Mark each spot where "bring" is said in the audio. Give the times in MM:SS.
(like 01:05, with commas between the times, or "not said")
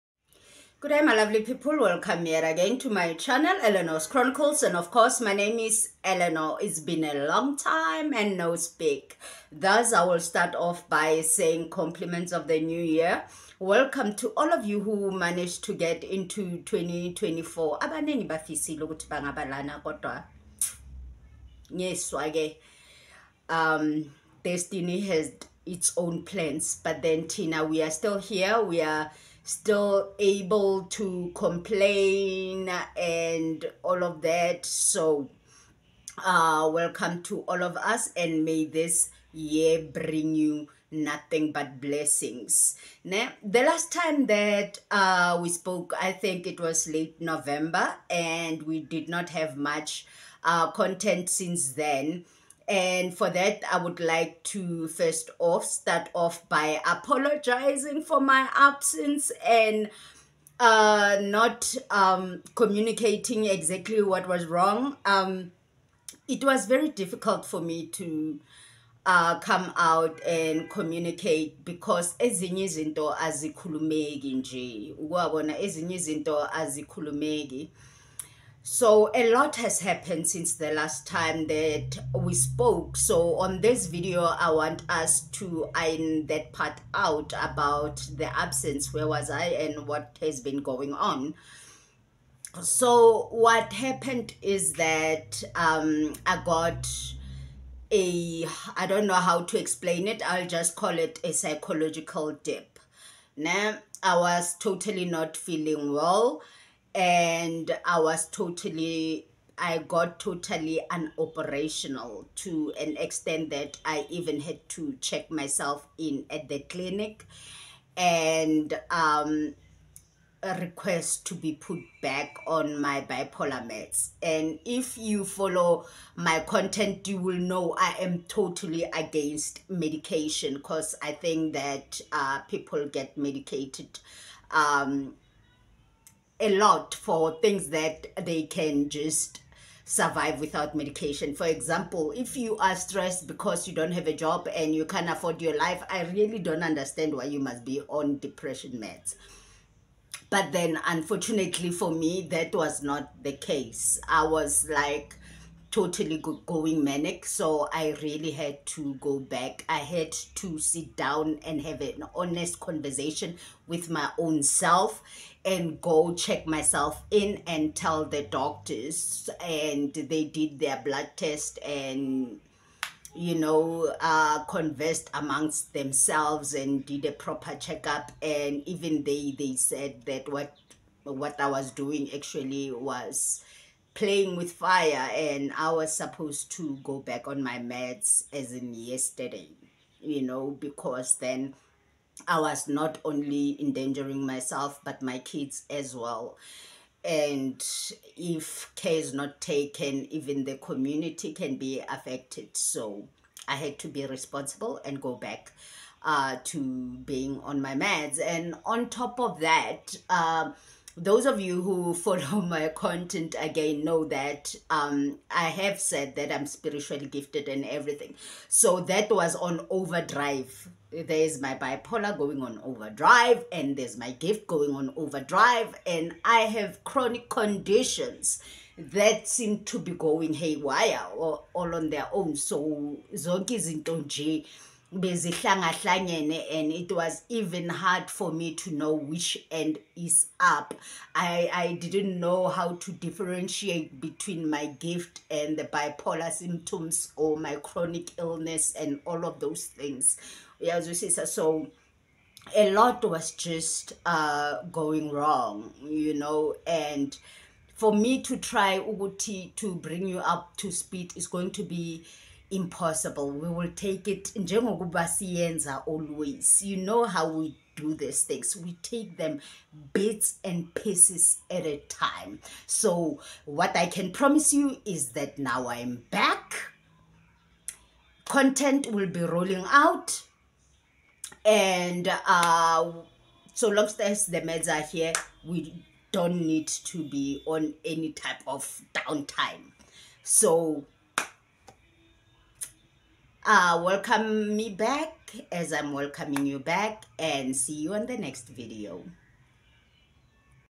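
00:39, 04:19.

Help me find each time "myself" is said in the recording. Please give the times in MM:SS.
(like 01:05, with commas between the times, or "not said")
01:55, 02:46, 03:14.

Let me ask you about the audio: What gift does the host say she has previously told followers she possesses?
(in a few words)
spiritually gifted.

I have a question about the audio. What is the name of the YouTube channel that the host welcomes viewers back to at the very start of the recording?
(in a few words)
Eleanor's Chronicles.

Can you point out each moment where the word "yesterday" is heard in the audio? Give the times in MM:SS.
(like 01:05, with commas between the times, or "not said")
03:08.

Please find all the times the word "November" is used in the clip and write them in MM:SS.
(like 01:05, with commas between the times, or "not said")
00:47.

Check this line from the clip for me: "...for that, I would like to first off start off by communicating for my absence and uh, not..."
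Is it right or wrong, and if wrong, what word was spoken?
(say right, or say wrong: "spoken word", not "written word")
wrong: "apologizing", not "communicating".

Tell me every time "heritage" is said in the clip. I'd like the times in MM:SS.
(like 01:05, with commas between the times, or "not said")
not said.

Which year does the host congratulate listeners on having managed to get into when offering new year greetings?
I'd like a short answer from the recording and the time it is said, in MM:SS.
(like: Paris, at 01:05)
2024, at 00:16.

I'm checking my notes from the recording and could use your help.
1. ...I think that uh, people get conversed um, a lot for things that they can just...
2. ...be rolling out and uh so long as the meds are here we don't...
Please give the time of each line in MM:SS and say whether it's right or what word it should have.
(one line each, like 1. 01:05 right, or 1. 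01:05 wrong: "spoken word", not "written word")
1. 02:11 wrong: "medicated", not "conversed"
2. 04:39 right.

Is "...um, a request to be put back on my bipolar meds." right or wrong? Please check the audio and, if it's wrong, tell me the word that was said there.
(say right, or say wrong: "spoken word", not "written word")
right.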